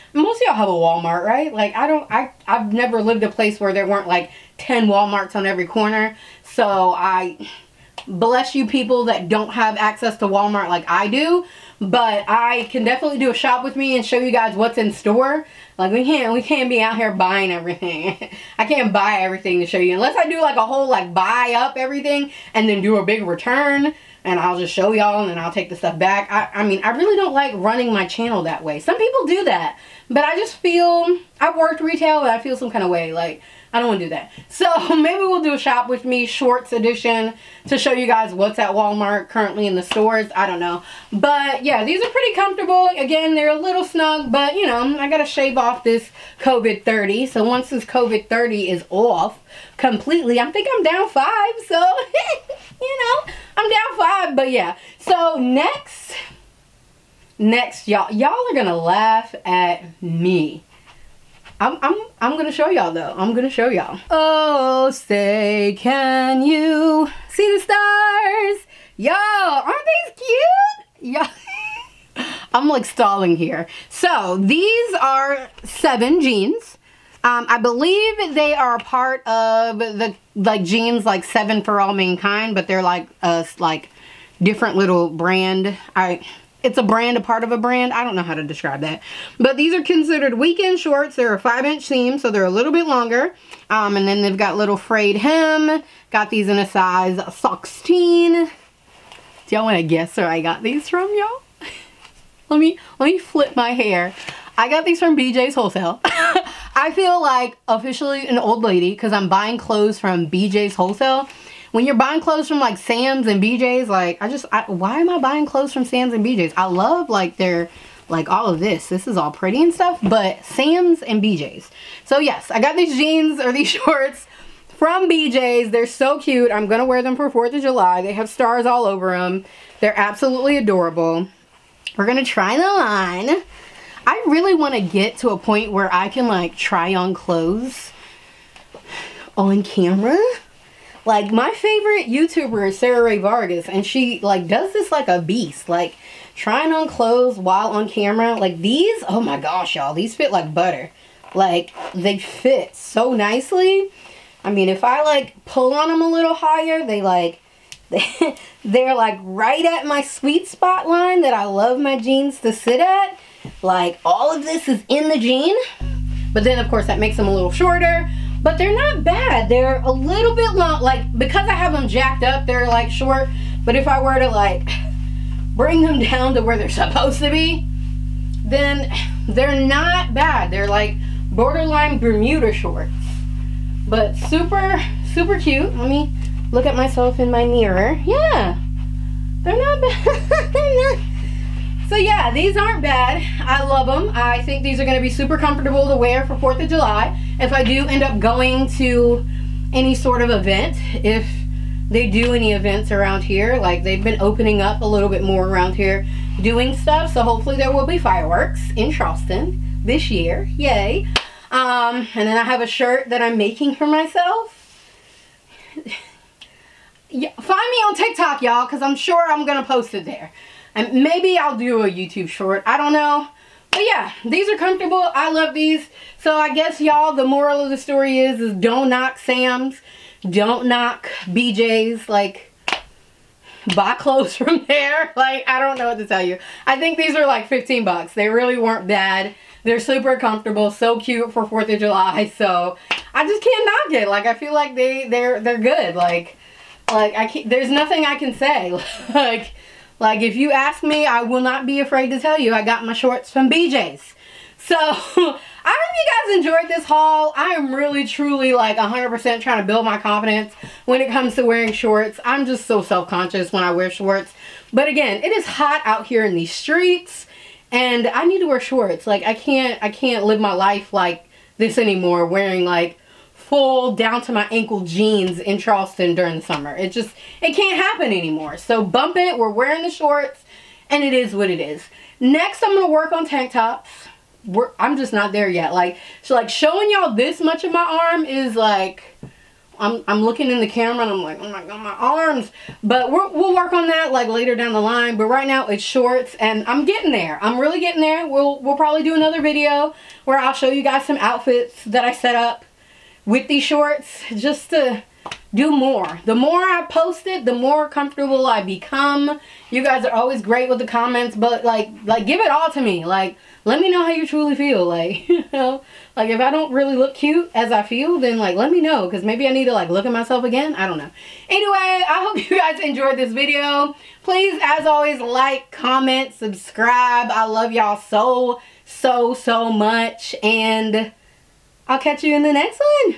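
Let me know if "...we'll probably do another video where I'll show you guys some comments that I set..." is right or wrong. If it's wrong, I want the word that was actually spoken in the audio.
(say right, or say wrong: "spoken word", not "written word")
wrong: "outfits", not "comments".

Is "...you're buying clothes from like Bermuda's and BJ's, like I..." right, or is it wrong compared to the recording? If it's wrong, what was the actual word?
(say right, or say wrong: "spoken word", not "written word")
wrong: "Sam", not "Bermuda".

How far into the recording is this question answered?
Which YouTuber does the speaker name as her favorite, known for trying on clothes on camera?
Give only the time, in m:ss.
2:22.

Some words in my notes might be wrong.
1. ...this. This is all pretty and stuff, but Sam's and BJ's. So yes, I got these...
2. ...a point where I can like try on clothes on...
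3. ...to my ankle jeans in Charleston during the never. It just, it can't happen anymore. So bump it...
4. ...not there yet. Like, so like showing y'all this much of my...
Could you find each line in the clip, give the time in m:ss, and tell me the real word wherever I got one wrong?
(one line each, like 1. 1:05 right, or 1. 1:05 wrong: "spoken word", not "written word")
1. 1:58 right
2. 2:15 right
3. 4:34 wrong: "summer", not "never"
4. 4:45 right.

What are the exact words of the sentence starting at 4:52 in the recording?
But we will work on that like later down the line.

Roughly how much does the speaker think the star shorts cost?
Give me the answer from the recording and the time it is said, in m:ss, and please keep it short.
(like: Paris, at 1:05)
$15, at 3:57.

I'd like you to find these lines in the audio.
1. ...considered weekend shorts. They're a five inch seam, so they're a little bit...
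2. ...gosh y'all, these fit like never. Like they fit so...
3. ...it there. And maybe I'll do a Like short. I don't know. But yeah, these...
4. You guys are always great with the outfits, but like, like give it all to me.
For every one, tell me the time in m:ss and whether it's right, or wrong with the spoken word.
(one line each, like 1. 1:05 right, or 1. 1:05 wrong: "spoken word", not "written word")
1. 1:29 right
2. 2:29 wrong: "butter", not "never"
3. 3:39 wrong: "YouTube", not "Like"
4. 5:09 wrong: "comments", not "outfits".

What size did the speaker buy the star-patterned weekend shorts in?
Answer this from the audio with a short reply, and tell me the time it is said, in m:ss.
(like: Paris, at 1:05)
16, at 1:36.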